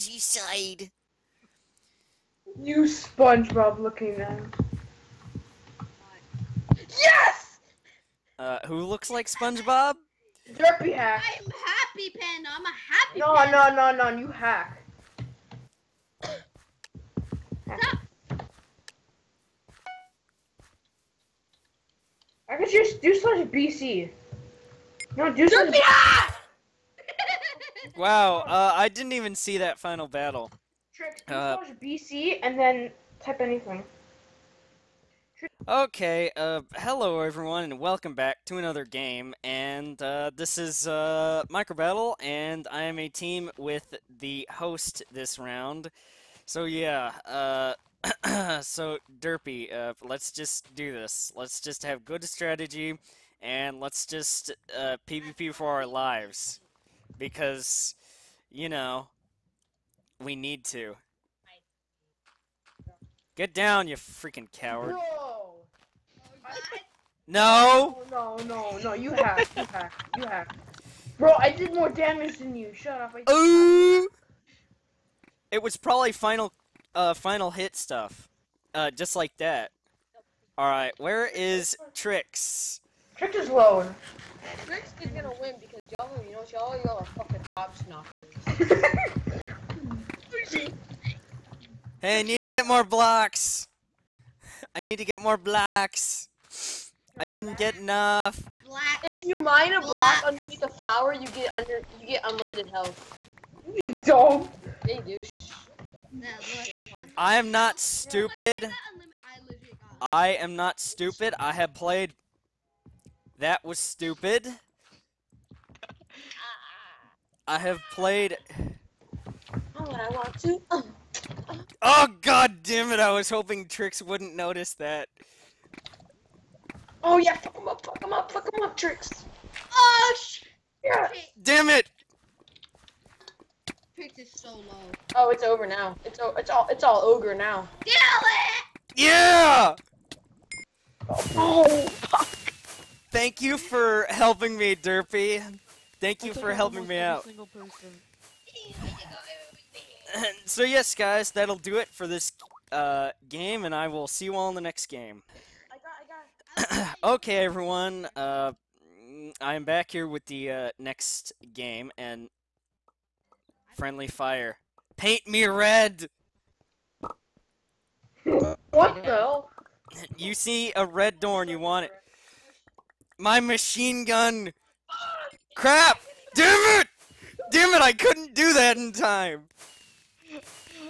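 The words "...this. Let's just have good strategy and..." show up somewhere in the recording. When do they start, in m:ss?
0:50.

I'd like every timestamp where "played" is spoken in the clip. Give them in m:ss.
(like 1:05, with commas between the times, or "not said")
1:51, 1:57.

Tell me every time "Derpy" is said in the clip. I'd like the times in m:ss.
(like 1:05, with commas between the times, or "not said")
0:10, 0:49, 2:24.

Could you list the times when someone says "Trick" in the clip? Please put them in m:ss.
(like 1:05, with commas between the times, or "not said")
0:30, 1:21.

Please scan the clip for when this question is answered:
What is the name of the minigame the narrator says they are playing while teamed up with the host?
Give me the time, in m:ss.
0:41.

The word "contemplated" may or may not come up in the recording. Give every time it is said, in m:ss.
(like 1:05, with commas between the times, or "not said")
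not said.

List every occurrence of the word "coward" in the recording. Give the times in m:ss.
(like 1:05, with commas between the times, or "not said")
1:04.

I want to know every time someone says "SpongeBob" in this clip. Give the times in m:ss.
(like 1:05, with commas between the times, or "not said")
0:02, 0:09.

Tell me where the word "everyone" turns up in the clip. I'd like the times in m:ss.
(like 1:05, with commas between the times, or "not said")
0:37, 2:37.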